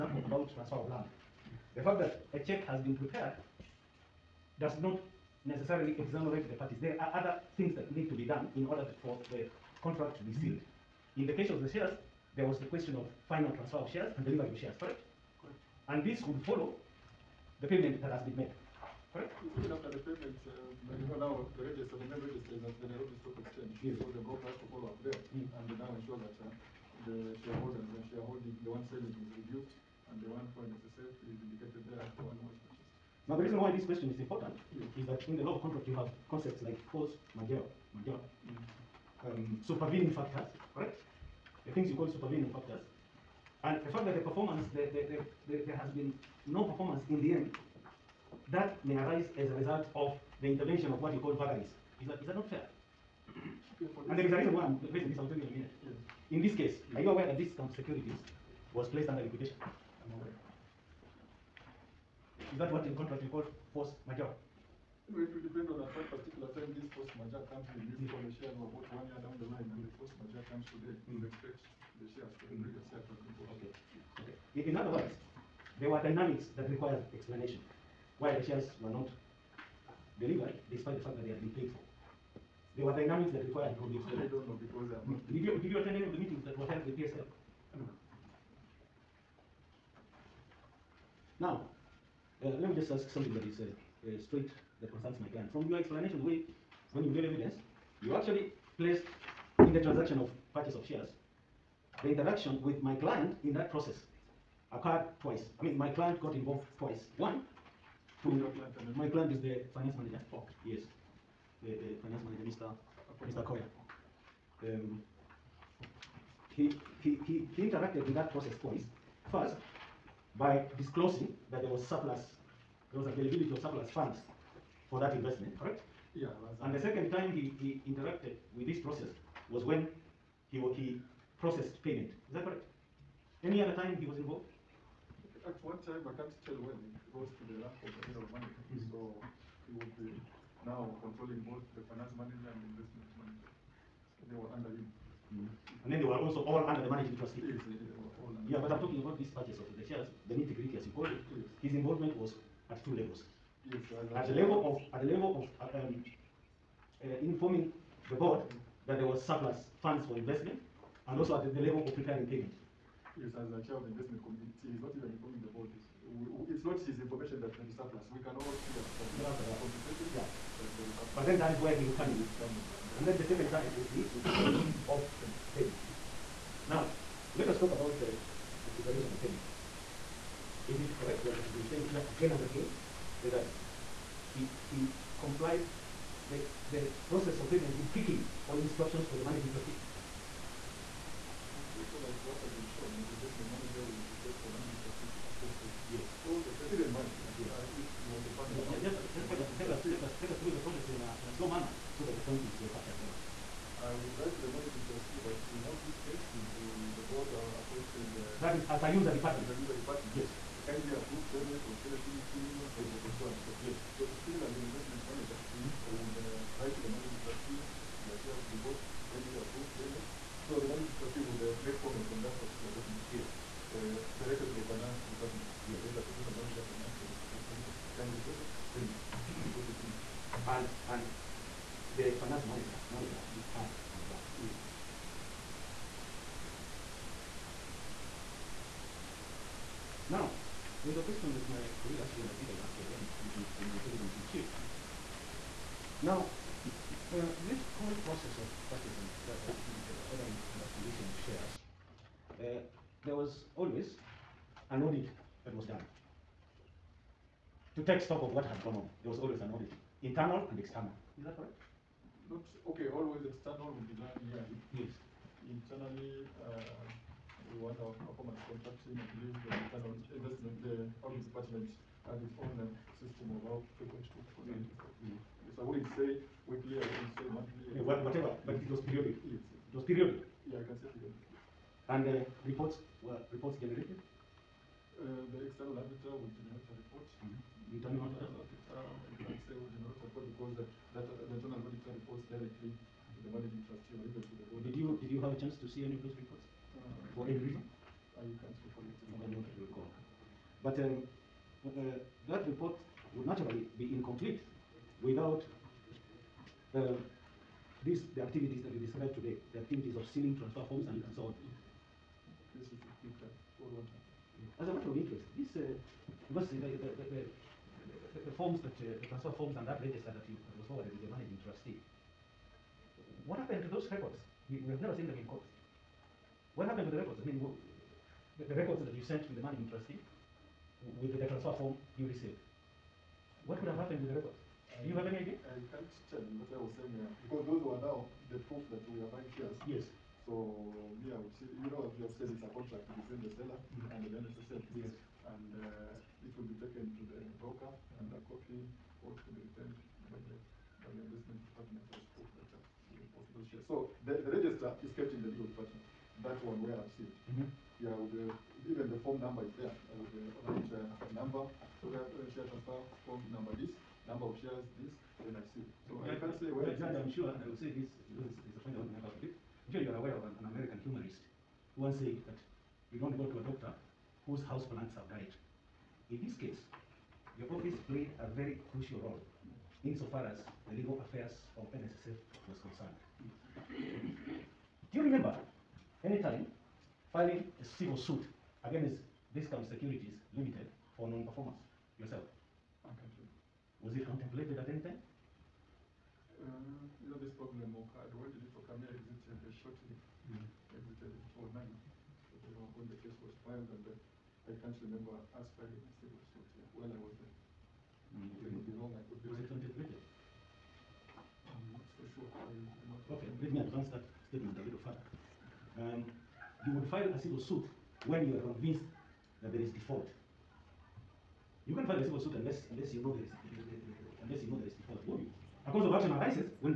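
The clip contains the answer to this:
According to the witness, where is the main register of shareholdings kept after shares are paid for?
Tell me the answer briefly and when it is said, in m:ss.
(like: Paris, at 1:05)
Nairobi Stock Exchange, at 0:22.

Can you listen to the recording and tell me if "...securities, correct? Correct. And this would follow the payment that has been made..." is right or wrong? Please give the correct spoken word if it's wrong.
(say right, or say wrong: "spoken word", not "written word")
wrong: "shares", not "securities".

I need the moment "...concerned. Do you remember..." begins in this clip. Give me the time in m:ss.
6:22.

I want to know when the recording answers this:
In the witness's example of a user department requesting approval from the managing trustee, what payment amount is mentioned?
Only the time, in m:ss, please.
3:31.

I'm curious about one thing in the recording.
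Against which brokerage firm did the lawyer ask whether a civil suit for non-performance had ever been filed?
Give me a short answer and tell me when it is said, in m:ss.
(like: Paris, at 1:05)
Discount Securities Limited, at 6:29.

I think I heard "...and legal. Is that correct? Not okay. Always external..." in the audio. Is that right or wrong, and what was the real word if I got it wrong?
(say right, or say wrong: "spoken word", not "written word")
wrong: "external", not "legal".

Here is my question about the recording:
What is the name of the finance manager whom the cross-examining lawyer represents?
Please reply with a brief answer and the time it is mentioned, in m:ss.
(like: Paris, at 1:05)
Mr. Koya, at 1:53.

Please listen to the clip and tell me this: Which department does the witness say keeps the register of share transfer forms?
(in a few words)
legal department.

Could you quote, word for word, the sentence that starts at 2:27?
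Yes, yeah, but I'm talking about this purchase of the shares, the nitty gritty as you call it.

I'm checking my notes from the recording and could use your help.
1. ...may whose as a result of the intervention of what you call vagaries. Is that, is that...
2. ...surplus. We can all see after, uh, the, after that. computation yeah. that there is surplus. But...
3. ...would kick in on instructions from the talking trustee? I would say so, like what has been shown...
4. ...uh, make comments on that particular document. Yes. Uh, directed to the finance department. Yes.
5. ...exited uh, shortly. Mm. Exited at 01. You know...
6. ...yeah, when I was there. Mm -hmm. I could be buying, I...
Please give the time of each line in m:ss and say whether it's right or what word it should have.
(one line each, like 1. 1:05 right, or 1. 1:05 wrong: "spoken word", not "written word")
1. 0:48 wrong: "arise", not "whose"
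2. 2:47 right
3. 3:07 wrong: "managing", not "talking"
4. 3:41 right
5. 6:38 wrong: "09", not "01"
6. 6:46 wrong: "wrong", not "buying".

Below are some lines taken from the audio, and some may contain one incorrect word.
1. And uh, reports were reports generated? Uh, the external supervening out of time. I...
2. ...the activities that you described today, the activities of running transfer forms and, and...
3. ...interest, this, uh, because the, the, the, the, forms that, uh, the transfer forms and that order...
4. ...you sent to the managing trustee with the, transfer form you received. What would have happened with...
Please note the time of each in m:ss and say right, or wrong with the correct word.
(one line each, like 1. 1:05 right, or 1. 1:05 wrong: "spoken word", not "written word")
1. 4:41 wrong: "running", not "supervening"
2. 5:08 wrong: "sealing", not "running"
3. 5:14 wrong: "register", not "order"
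4. 5:28 right.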